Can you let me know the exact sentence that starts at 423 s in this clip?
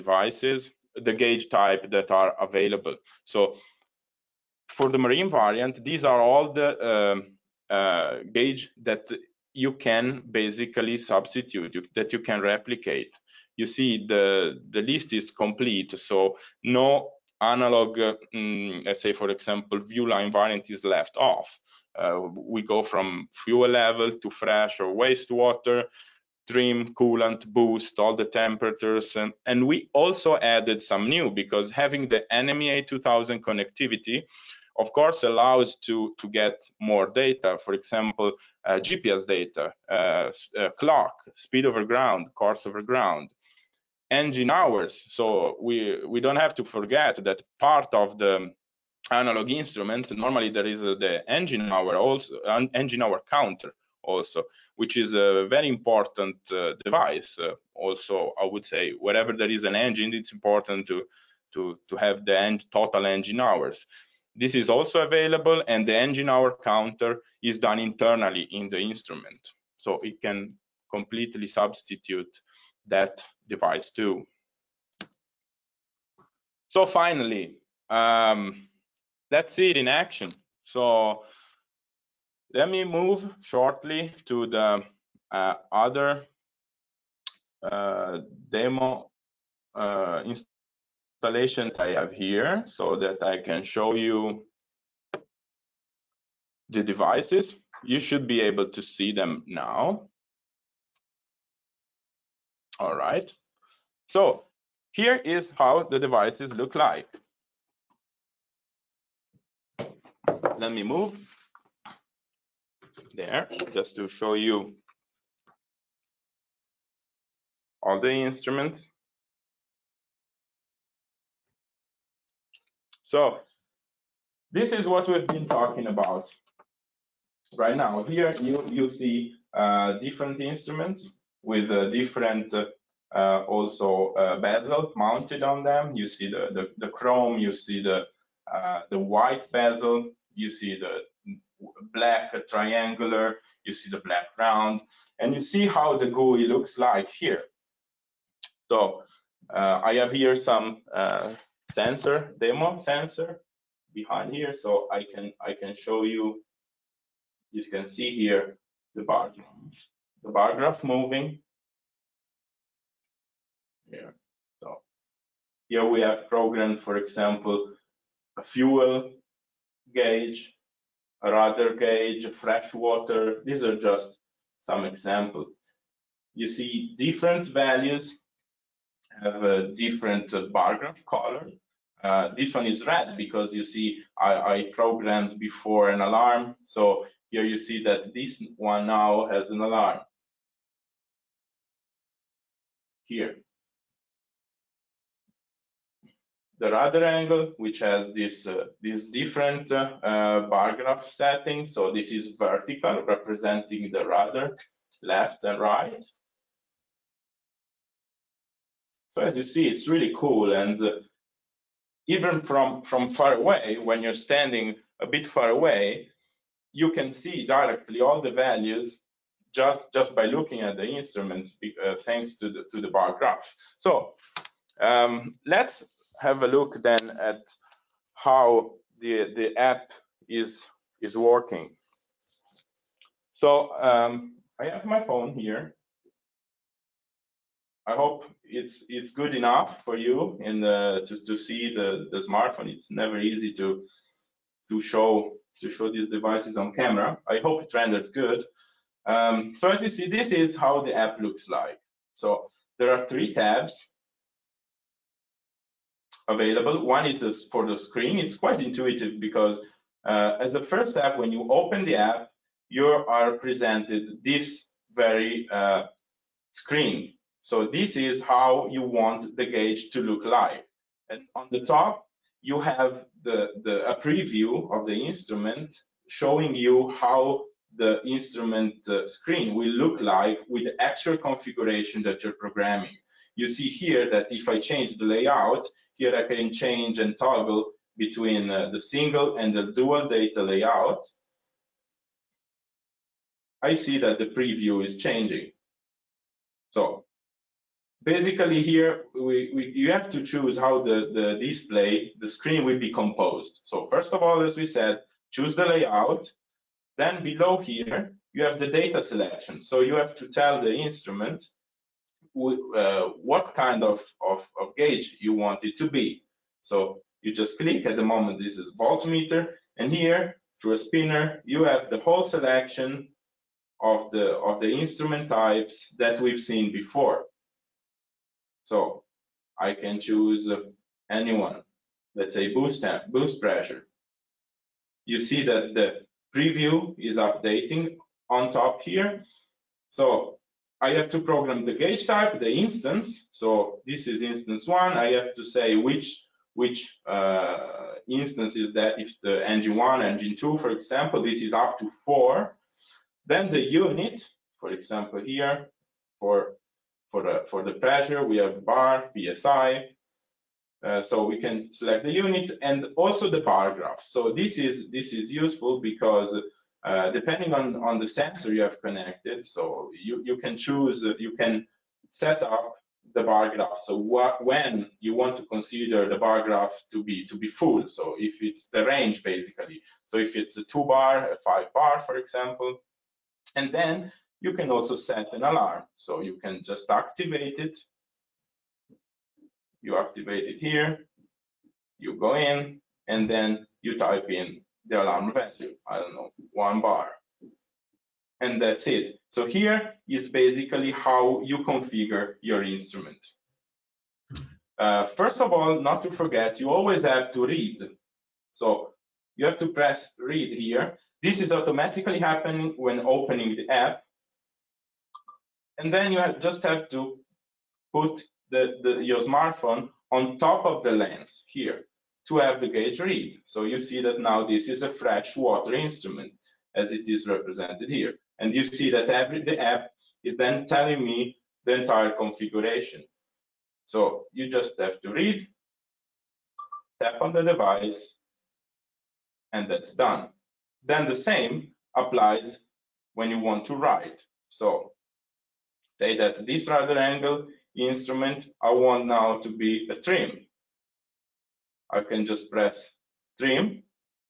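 So you see that now this is a fresh water instrument as it is represented here.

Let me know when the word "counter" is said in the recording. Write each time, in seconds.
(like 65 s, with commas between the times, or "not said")
53 s, 66 s.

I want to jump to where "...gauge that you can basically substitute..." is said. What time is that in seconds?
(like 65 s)
8 s.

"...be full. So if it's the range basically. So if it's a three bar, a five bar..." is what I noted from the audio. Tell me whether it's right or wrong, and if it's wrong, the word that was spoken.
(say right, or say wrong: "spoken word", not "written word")
wrong: "two", not "three".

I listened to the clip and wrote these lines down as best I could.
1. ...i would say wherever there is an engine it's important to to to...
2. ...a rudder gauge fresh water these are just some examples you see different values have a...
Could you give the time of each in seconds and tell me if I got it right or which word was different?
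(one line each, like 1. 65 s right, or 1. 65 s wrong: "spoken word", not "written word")
1. 58 s right
2. 171 s right.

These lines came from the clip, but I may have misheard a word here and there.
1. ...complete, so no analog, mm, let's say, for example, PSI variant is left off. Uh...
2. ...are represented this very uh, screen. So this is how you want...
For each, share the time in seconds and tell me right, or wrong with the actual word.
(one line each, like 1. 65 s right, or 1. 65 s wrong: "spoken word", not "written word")
1. 15 s wrong: "Viewline", not "PSI"
2. 262 s wrong: "presented", not "represented".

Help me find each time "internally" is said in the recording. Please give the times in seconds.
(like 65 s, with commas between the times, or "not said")
67 s.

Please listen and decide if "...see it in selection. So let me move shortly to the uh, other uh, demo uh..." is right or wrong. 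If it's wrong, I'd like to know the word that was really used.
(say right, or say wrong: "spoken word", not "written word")
wrong: "action", not "selection".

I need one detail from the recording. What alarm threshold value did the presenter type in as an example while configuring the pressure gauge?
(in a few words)
1 bar.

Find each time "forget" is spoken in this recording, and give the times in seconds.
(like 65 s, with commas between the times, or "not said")
46 s, 406 s.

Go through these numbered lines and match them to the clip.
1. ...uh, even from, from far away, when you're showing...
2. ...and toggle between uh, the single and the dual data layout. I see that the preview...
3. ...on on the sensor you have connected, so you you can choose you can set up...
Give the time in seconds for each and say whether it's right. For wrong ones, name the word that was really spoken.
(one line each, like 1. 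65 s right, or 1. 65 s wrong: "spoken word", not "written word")
1. 210 s wrong: "standing", not "showing"
2. 286 s right
3. 367 s right.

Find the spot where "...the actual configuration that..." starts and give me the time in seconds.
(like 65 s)
280 s.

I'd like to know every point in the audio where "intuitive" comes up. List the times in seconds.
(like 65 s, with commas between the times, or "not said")
258 s.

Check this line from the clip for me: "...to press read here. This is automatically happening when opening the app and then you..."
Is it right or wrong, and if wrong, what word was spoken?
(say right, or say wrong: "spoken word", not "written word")
right.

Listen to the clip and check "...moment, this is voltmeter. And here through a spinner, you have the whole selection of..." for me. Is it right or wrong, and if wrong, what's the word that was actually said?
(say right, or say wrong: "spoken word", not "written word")
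right.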